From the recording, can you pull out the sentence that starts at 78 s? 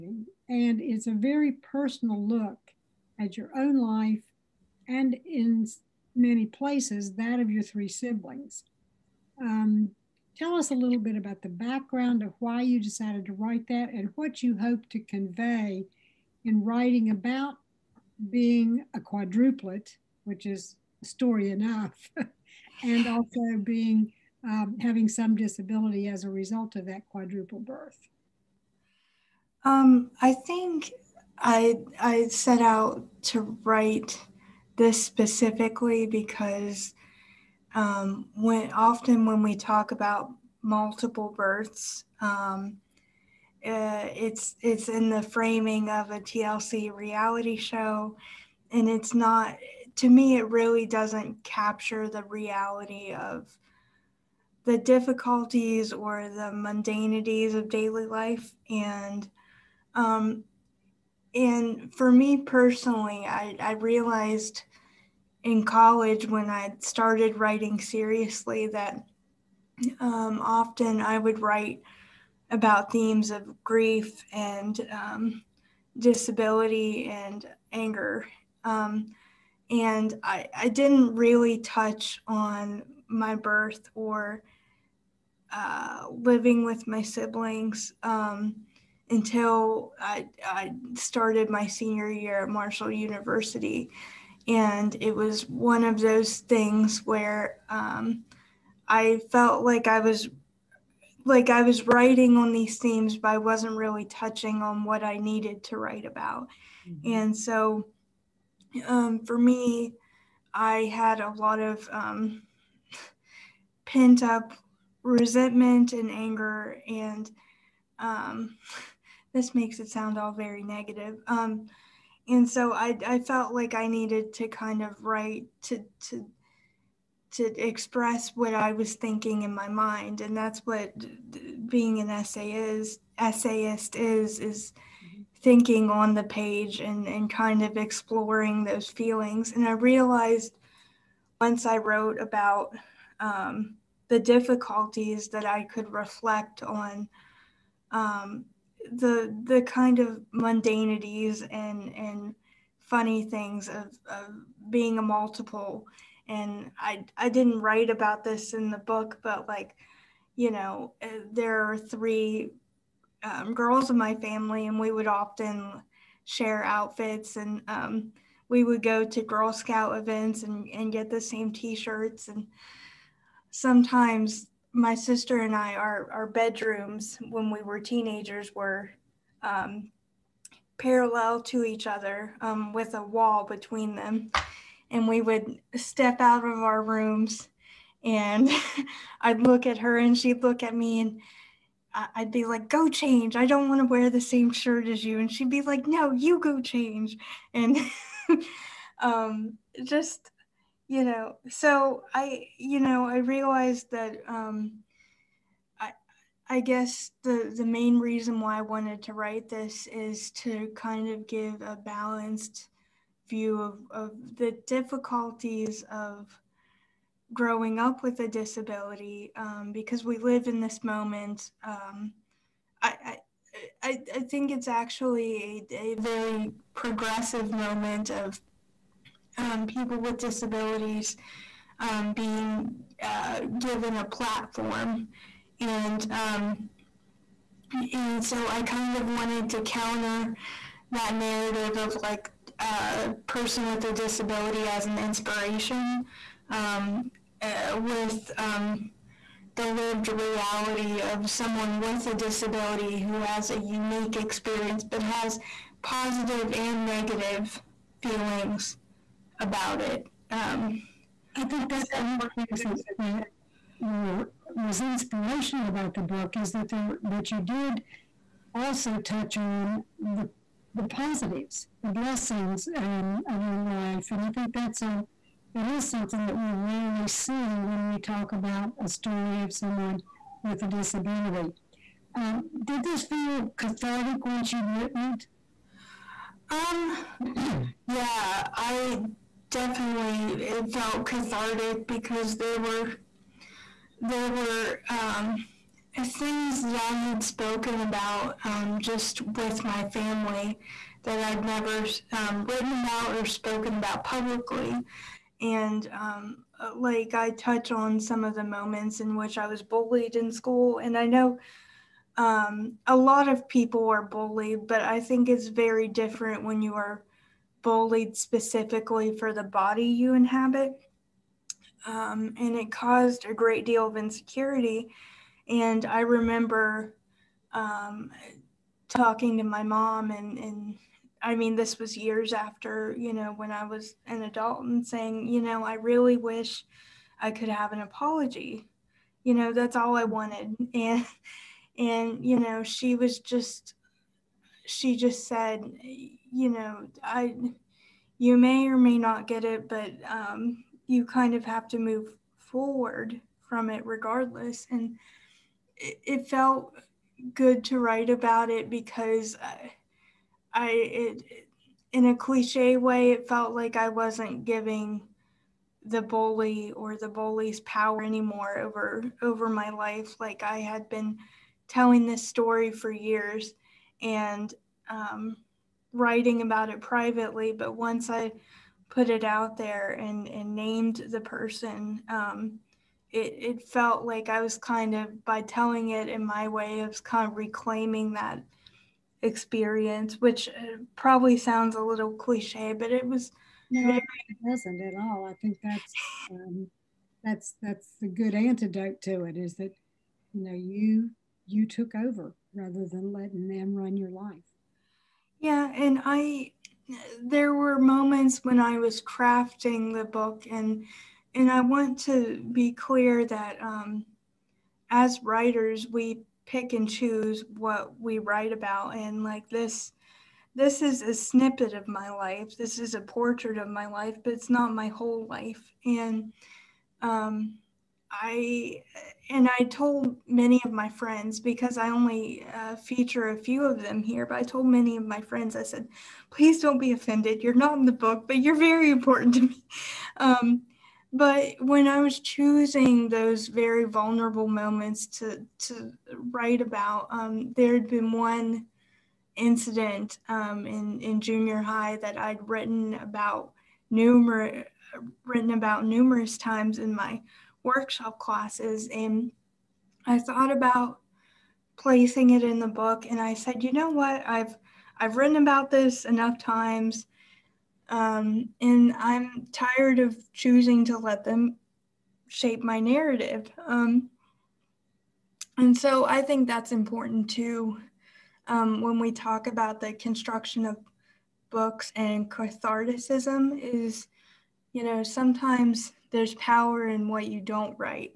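Um, and I, I didn't really touch on my birth or uh, living with my siblings.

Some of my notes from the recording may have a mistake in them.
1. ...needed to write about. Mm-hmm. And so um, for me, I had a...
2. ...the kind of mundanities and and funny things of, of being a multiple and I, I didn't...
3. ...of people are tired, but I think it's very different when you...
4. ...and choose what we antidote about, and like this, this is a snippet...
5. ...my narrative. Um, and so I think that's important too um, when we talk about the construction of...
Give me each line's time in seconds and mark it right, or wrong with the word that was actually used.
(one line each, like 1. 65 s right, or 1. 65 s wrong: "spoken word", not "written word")
1. 105 s right
2. 149 s right
3. 313 s wrong: "bullied", not "tired"
4. 416 s wrong: "write", not "antidote"
5. 472 s right.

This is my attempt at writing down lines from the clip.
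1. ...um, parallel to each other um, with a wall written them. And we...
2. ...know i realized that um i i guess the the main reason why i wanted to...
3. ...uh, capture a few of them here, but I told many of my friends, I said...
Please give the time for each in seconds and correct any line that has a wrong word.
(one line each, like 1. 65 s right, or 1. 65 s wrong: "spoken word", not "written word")
1. 179 s wrong: "between", not "written"
2. 202 s right
3. 432 s wrong: "feature", not "capture".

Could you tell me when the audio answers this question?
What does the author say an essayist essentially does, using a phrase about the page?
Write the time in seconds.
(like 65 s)
135 s.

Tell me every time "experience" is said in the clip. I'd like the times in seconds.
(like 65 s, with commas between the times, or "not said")
254 s, 389 s.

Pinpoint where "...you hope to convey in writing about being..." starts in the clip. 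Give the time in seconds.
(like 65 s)
14 s.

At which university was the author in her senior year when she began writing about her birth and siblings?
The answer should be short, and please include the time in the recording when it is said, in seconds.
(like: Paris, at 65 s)
Marshall University, at 92 s.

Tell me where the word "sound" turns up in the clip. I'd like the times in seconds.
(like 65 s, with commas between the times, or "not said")
119 s, 391 s.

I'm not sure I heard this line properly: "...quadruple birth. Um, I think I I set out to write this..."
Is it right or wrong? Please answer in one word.
right.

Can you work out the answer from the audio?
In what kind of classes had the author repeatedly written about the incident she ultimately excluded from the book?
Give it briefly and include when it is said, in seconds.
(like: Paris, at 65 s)
Workshop classes, at 457 s.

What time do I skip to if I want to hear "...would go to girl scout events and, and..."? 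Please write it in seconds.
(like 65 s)
168 s.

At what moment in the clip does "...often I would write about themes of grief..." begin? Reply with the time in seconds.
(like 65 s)
70 s.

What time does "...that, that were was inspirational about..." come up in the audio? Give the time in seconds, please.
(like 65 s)
262 s.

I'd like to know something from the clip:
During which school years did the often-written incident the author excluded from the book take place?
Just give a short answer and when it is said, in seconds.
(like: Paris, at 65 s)
Junior high, at 451 s.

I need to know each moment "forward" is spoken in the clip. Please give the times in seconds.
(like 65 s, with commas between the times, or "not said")
352 s.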